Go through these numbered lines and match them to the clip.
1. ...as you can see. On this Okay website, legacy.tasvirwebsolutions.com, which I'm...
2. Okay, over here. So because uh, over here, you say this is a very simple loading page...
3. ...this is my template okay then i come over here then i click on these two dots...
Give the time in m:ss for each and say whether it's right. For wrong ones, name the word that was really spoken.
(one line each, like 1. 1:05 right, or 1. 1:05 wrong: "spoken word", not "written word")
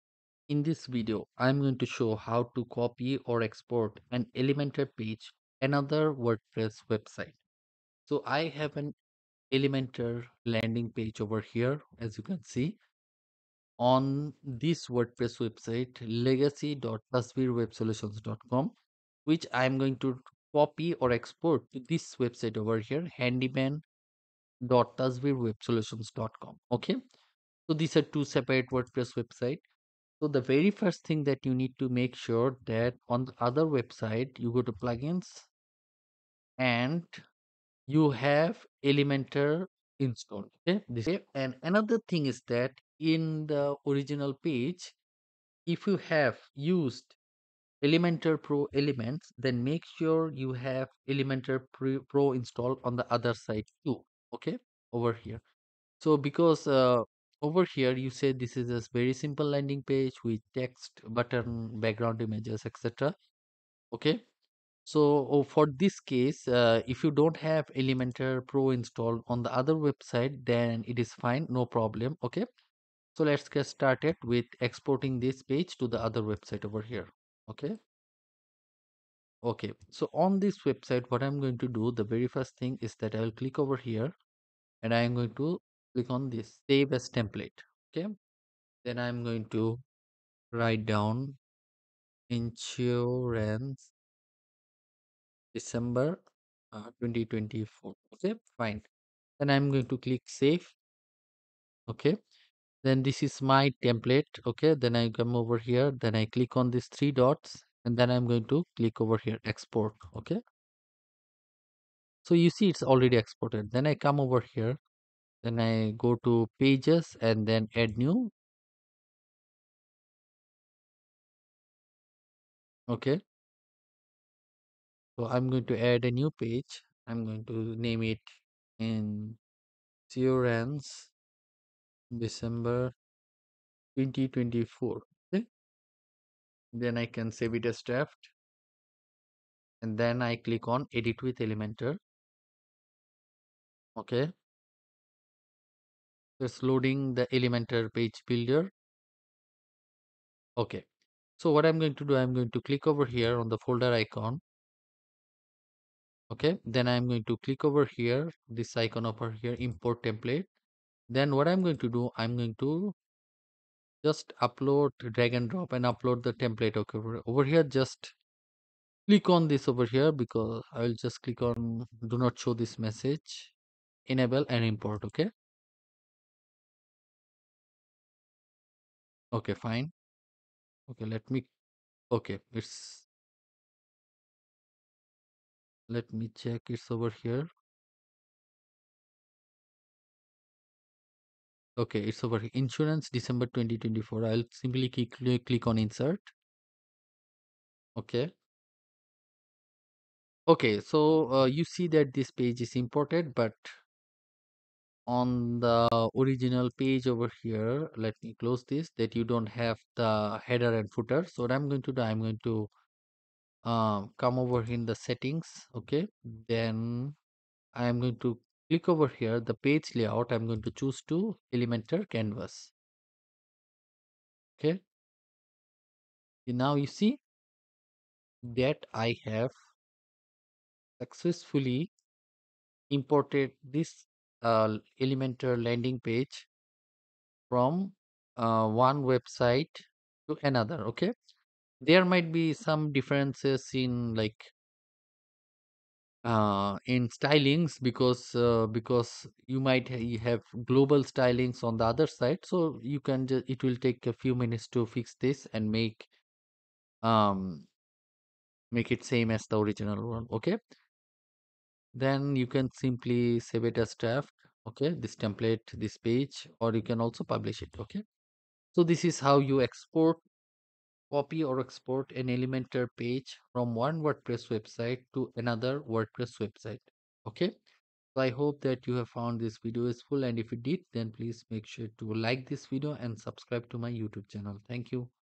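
1. 0:11 wrong: "WordPress", not "Okay"
2. 0:54 wrong: "landing", not "loading"
3. 1:43 wrong: "three", not "two".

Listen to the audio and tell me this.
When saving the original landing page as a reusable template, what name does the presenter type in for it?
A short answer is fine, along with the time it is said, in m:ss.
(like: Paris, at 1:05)
Insurance December 2024, at 1:32.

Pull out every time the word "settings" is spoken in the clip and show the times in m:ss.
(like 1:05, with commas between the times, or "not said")
3:35.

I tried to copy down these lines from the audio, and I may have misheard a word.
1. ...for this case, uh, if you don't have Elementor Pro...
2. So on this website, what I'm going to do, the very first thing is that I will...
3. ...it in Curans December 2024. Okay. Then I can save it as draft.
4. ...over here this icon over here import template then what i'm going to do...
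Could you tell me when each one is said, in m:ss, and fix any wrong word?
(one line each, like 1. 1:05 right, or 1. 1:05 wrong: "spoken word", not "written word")
1. 1:05 right
2. 1:19 right
3. 2:08 right
4. 2:37 right.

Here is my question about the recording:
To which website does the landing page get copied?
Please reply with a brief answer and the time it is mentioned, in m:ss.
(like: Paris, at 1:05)
handyman.tasvirwebsolutions.com, at 0:23.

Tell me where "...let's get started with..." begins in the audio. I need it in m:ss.
1:13.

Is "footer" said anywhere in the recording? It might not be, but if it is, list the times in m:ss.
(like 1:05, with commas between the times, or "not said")
3:30.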